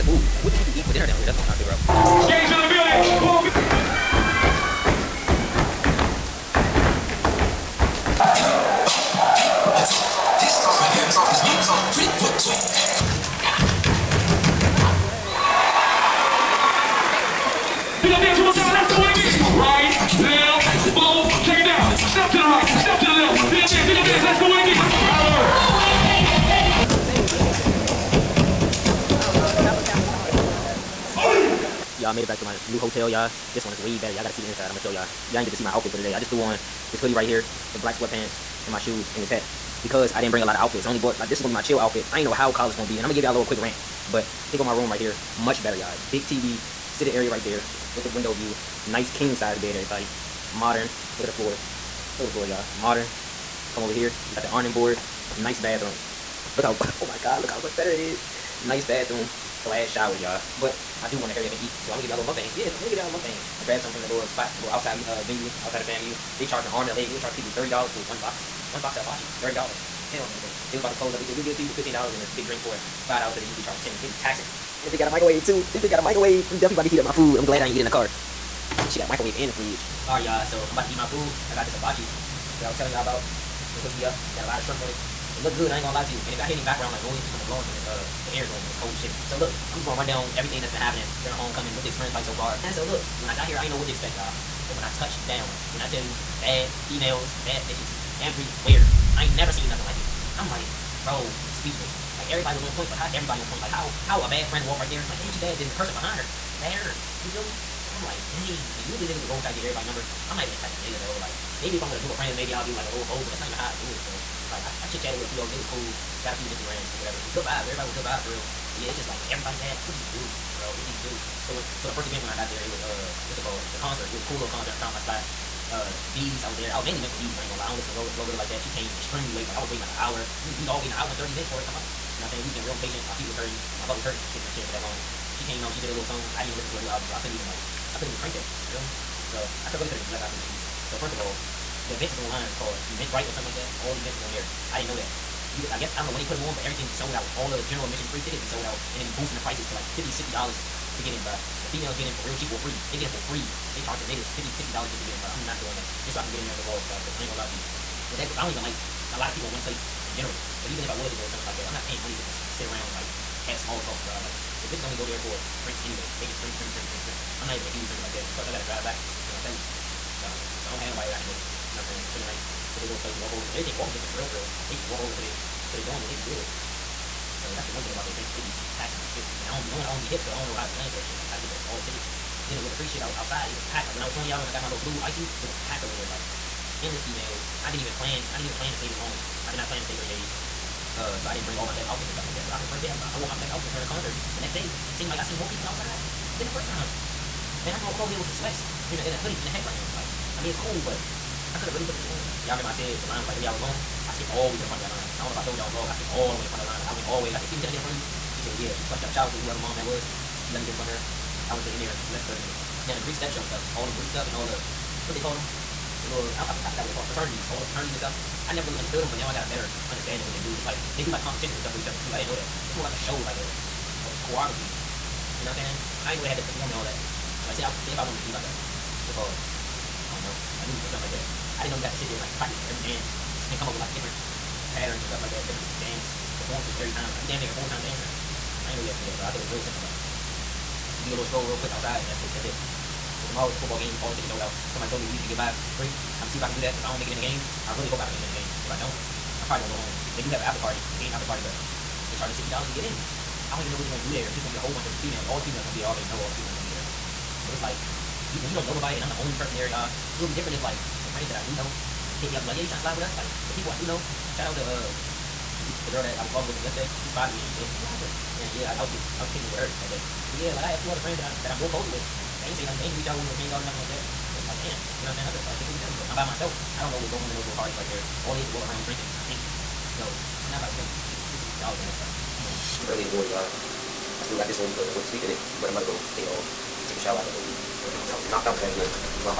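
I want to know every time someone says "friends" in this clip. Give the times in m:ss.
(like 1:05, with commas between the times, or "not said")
1:44, 1:52, 4:21, 4:30.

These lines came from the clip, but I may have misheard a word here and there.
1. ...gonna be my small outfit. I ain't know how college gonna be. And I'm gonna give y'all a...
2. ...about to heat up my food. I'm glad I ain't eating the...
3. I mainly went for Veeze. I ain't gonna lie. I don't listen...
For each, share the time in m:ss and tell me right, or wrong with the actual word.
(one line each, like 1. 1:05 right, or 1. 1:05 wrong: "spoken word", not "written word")
1. 0:41 wrong: "chill", not "small"
2. 1:16 right
3. 2:06 right.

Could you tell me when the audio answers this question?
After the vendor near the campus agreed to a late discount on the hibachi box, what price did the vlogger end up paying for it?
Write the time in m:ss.
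1:11.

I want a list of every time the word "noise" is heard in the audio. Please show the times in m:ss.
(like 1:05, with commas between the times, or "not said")
1:27.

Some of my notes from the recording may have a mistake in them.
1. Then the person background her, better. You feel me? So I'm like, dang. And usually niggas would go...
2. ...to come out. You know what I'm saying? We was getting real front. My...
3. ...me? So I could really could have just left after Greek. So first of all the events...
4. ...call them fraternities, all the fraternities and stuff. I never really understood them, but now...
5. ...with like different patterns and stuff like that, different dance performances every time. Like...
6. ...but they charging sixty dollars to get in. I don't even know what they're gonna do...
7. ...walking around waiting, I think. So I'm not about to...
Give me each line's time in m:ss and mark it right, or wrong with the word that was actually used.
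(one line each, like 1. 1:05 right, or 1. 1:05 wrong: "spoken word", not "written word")
1. 1:45 wrong: "behind", not "background"
2. 2:11 wrong: "impatient", not "front"
3. 2:18 wrong: "Veeze", not "Greek"
4. 3:36 right
5. 3:53 right
6. 4:11 right
7. 4:38 wrong: "drinking", not "waiting".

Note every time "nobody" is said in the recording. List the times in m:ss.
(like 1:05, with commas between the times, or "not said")
2:50, 4:18.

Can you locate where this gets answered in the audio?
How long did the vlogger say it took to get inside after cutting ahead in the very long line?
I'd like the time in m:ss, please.
3:32.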